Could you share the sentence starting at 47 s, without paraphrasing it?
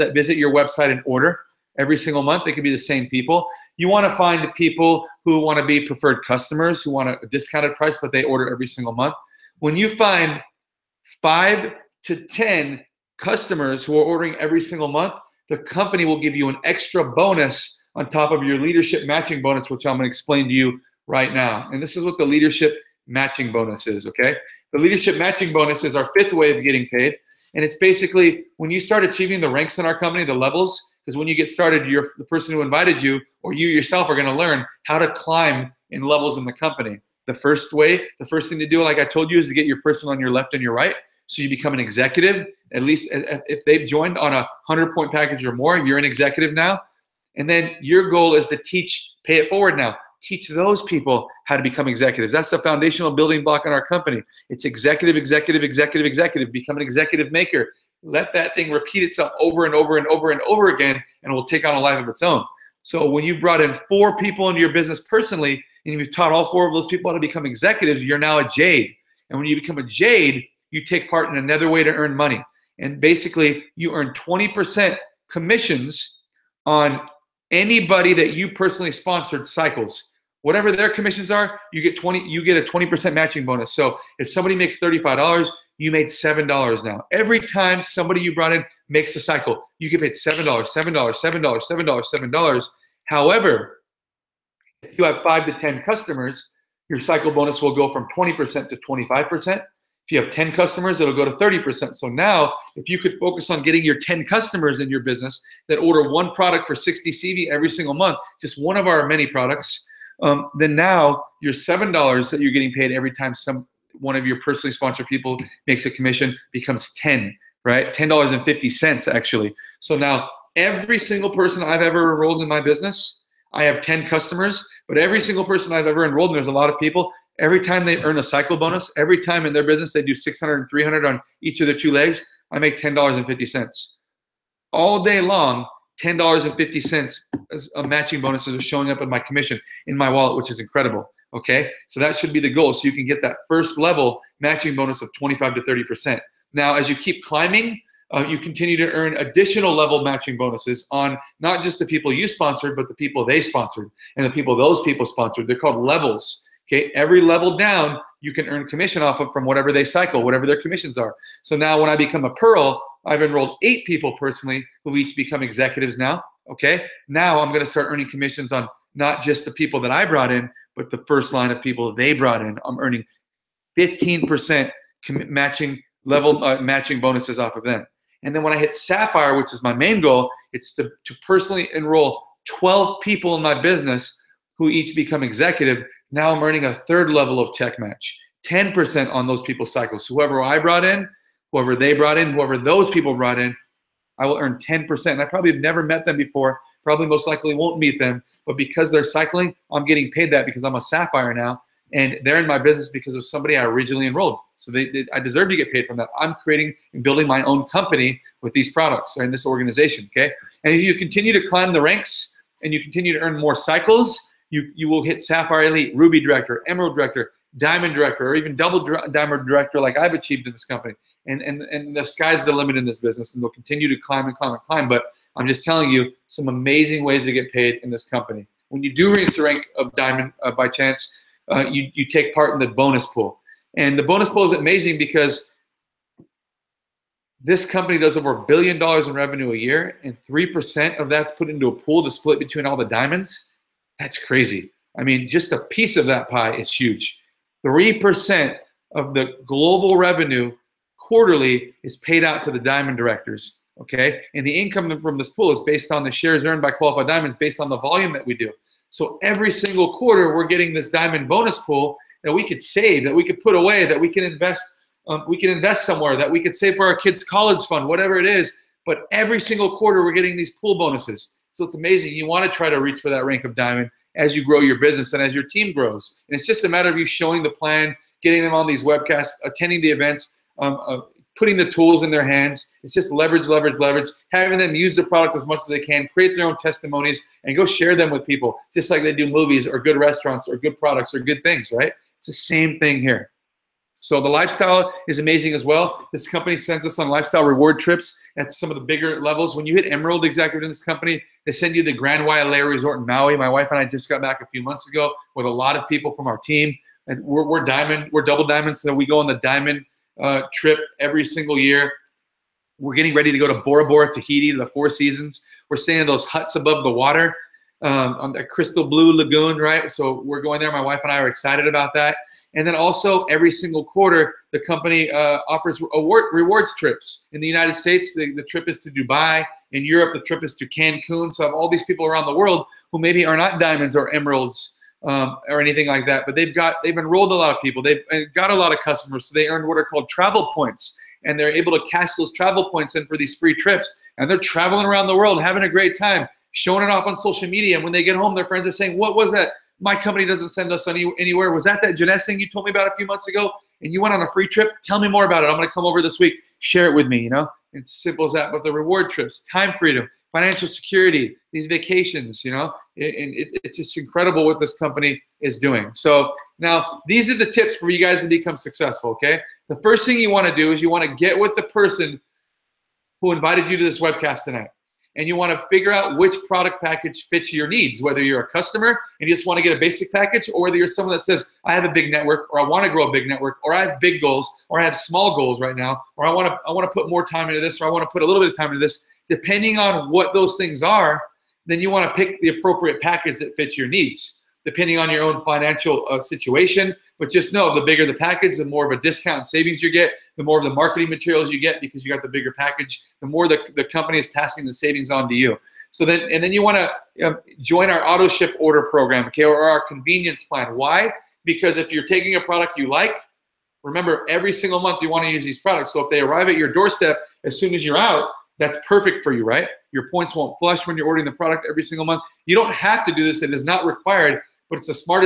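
And then your goal is to teach, pay it forward now.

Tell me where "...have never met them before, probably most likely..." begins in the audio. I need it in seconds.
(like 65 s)
195 s.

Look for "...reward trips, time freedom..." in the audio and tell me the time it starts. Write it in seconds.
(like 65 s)
358 s.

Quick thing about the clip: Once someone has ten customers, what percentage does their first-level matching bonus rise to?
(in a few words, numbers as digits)
30%.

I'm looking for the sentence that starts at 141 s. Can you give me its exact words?
Okay, so that should be the goal.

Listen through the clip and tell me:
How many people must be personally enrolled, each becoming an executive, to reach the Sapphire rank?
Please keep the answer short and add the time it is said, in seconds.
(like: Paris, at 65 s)
12, at 182 s.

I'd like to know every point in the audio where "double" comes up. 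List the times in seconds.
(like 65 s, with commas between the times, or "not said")
218 s, 308 s.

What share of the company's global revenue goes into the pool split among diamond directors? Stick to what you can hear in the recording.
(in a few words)
3%.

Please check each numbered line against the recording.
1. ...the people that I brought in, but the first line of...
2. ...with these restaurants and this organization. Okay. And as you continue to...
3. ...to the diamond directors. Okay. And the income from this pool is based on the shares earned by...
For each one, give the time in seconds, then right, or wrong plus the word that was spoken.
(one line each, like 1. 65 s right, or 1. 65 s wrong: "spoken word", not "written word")
1. 169 s right
2. 208 s wrong: "products", not "restaurants"
3. 252 s right.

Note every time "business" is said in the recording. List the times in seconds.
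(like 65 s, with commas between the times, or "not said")
64 s, 105 s, 122 s, 129 s, 183 s, 202 s, 222 s, 274 s.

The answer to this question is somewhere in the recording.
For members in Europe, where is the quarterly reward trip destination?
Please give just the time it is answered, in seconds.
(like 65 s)
330 s.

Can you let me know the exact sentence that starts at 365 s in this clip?
So now these are the tips for you guys to become successful, okay?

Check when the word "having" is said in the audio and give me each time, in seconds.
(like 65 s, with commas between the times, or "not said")
284 s, 345 s.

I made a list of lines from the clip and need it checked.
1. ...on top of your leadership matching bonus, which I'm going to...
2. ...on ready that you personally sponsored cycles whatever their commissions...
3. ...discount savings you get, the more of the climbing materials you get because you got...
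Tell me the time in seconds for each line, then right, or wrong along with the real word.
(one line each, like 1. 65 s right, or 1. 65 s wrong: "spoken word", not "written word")
1. 17 s right
2. 76 s wrong: "anybody", not "ready"
3. 399 s wrong: "marketing", not "climbing".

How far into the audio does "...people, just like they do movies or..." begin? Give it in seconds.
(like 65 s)
288 s.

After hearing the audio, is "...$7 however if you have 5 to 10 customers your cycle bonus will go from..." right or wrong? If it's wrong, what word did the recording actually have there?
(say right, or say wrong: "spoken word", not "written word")
right.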